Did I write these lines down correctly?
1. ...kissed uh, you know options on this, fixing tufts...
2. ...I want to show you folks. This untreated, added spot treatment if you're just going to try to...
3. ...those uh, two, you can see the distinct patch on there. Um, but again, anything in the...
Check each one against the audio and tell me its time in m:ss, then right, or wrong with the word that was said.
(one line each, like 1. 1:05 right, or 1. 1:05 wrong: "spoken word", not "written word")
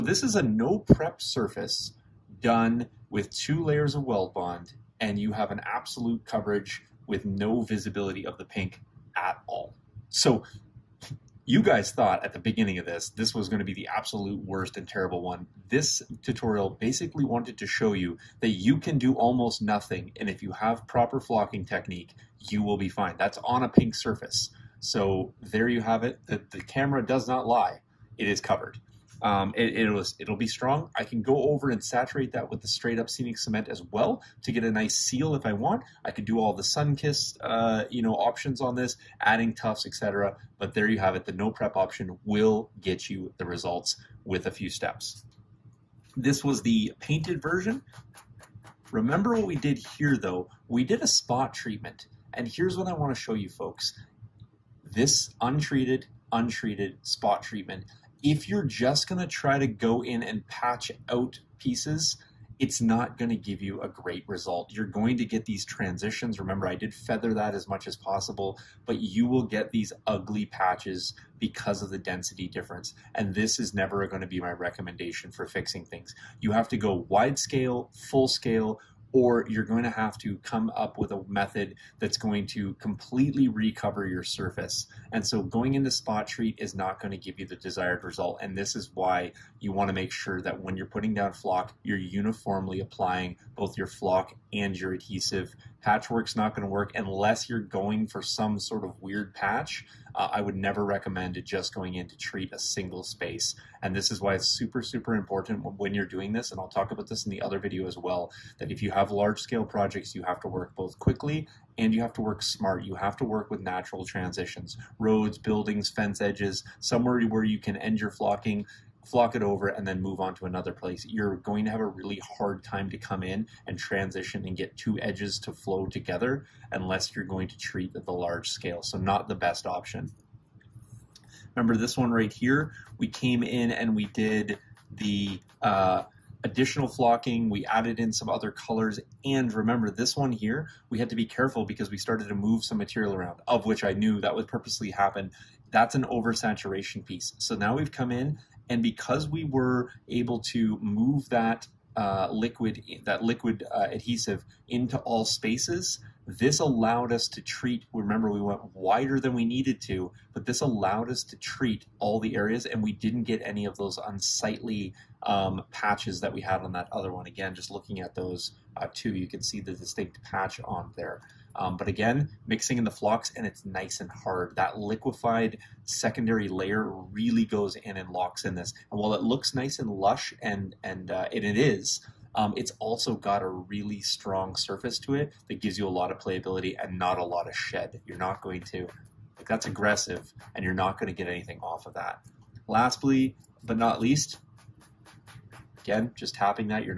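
1. 0:36 wrong: "adding", not "fixing"
2. 0:52 wrong: "untreated", not "added"
3. 2:48 wrong: "mixing", not "anything".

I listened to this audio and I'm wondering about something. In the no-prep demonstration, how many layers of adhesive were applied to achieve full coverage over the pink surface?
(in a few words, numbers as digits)
2.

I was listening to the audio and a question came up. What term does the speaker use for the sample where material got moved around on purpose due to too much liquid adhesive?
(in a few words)
Oversaturation piece.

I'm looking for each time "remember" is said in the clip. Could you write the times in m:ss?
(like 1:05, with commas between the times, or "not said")
0:48, 1:06, 2:11, 2:19, 2:37.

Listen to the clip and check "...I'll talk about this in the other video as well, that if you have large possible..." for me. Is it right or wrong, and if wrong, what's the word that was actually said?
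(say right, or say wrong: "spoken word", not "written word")
wrong: "scale", not "possible".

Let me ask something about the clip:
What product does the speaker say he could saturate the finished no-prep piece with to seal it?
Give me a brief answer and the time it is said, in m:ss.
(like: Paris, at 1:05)
Scenic cement, at 0:33.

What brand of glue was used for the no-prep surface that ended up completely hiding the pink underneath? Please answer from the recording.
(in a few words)
Weldbond.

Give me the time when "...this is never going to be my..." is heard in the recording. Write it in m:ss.
1:13.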